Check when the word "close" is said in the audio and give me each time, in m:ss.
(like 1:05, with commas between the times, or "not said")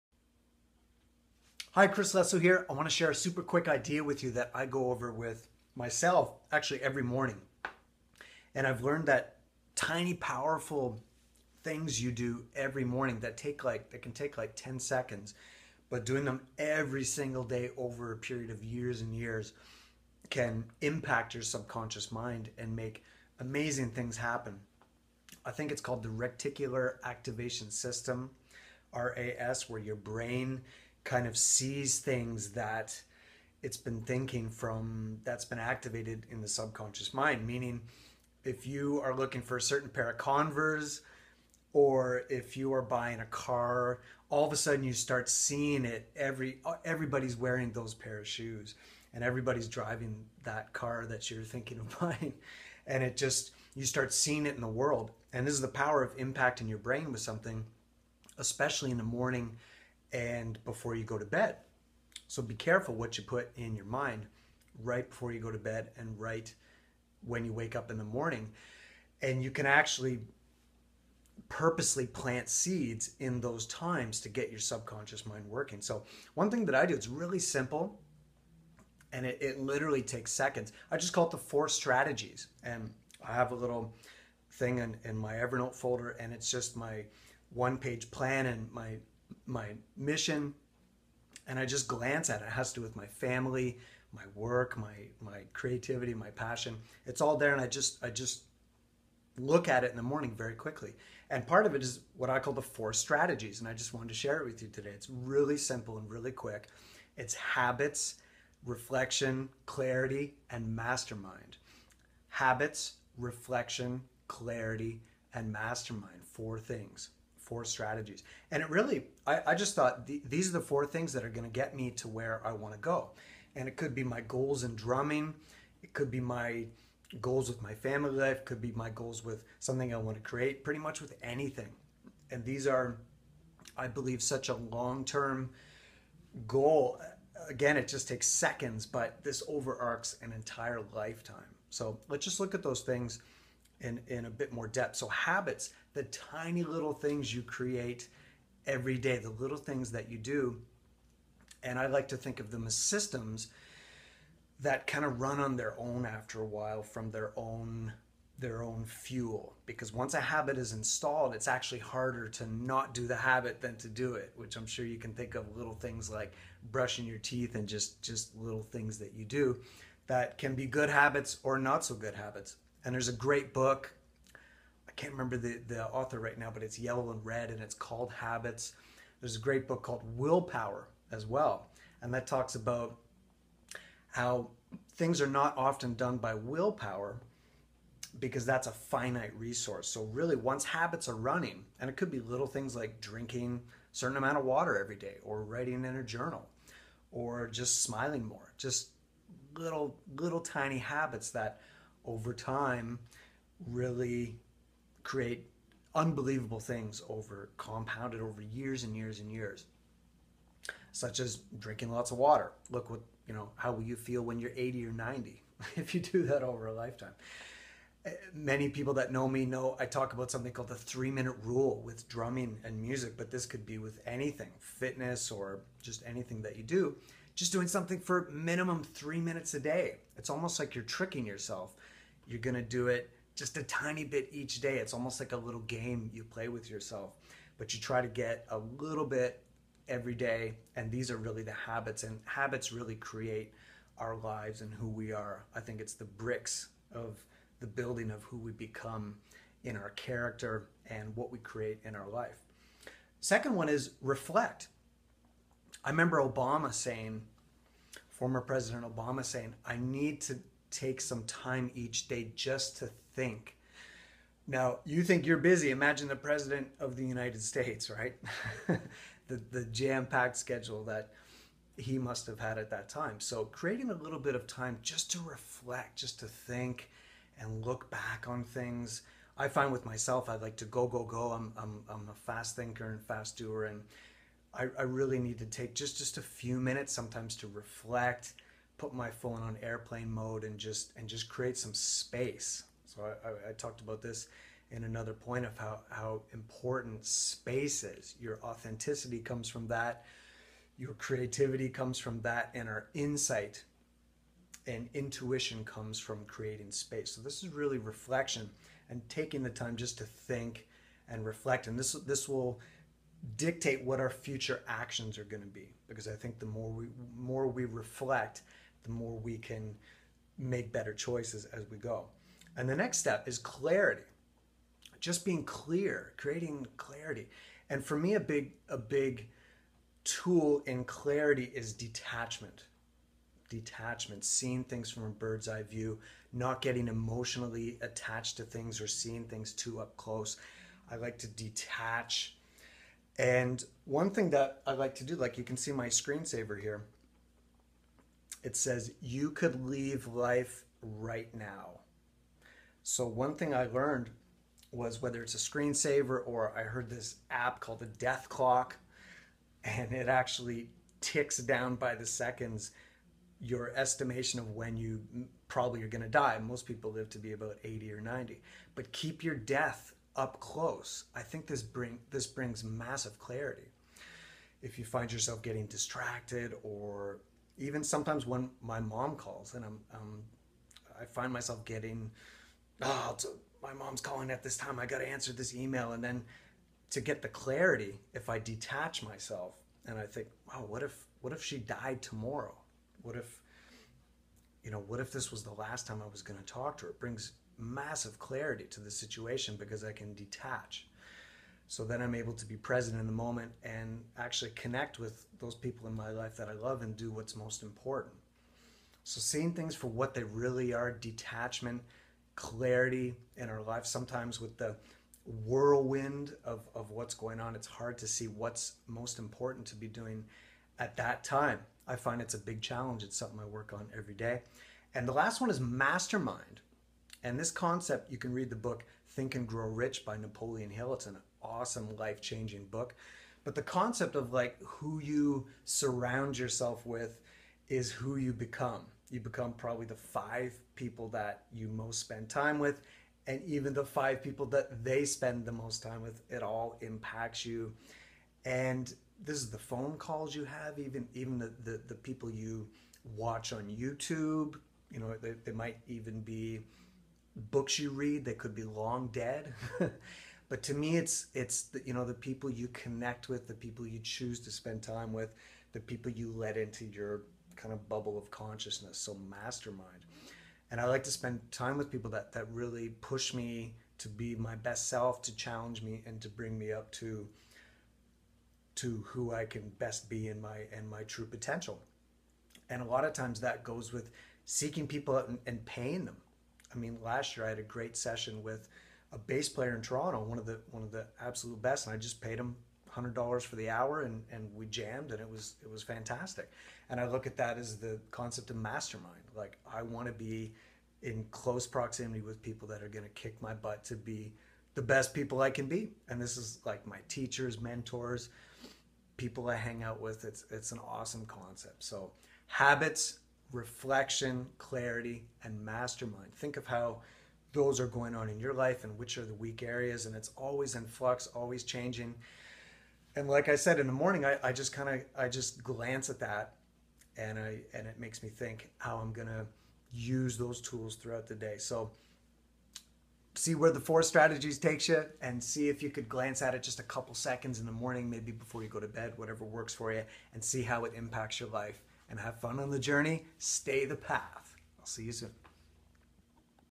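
5:39, 6:10, 8:21.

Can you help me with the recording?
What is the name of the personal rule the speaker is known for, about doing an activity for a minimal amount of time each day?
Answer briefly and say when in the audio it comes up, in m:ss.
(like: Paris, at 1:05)
Three minute rule, at 3:40.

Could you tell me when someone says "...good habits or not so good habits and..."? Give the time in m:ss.
2:50.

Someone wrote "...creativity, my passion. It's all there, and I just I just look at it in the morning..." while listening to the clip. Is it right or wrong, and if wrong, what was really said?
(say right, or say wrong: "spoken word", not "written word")
right.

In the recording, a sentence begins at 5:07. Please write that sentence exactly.
So this is really reflection and taking the time just to think and reflect.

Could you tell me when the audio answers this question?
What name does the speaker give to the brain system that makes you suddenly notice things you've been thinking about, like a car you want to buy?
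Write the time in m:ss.
0:26.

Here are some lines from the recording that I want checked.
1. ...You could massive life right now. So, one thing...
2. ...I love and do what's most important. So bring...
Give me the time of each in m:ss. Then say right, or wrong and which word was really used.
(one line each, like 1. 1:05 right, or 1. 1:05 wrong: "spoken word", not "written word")
1. 5:49 wrong: "leave", not "massive"
2. 6:46 wrong: "seeing", not "bring".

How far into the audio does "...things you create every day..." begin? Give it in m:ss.
2:26.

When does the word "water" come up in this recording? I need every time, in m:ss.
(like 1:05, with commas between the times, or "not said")
3:14, 3:32.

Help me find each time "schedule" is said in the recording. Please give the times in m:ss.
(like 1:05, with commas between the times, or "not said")
4:30.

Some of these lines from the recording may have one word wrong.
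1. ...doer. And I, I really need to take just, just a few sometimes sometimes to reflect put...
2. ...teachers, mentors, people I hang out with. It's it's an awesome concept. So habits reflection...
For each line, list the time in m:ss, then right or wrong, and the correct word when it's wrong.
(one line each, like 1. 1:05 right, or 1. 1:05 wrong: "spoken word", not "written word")
1. 4:43 wrong: "minutes", not "sometimes"
2. 8:27 right.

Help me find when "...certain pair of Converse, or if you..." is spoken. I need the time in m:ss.
0:39.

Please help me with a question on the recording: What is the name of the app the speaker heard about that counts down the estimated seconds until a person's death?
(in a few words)
Death Clock.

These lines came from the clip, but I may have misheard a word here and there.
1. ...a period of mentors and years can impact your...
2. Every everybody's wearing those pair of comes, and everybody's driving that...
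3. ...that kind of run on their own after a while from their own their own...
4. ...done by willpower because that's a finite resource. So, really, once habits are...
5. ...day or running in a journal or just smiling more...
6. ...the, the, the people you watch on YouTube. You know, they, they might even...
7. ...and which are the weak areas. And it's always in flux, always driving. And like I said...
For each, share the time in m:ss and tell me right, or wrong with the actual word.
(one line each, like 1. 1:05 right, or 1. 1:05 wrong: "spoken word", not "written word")
1. 0:18 wrong: "years", not "mentors"
2. 0:46 wrong: "shoes", not "comes"
3. 2:34 right
4. 3:05 right
5. 3:14 wrong: "writing", not "running"
6. 7:31 right
7. 8:38 wrong: "changing", not "driving".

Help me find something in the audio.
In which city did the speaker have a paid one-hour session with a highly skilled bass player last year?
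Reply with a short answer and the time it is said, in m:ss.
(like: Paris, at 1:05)
Toronto, at 8:09.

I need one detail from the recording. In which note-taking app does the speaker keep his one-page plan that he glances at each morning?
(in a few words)
Evernote.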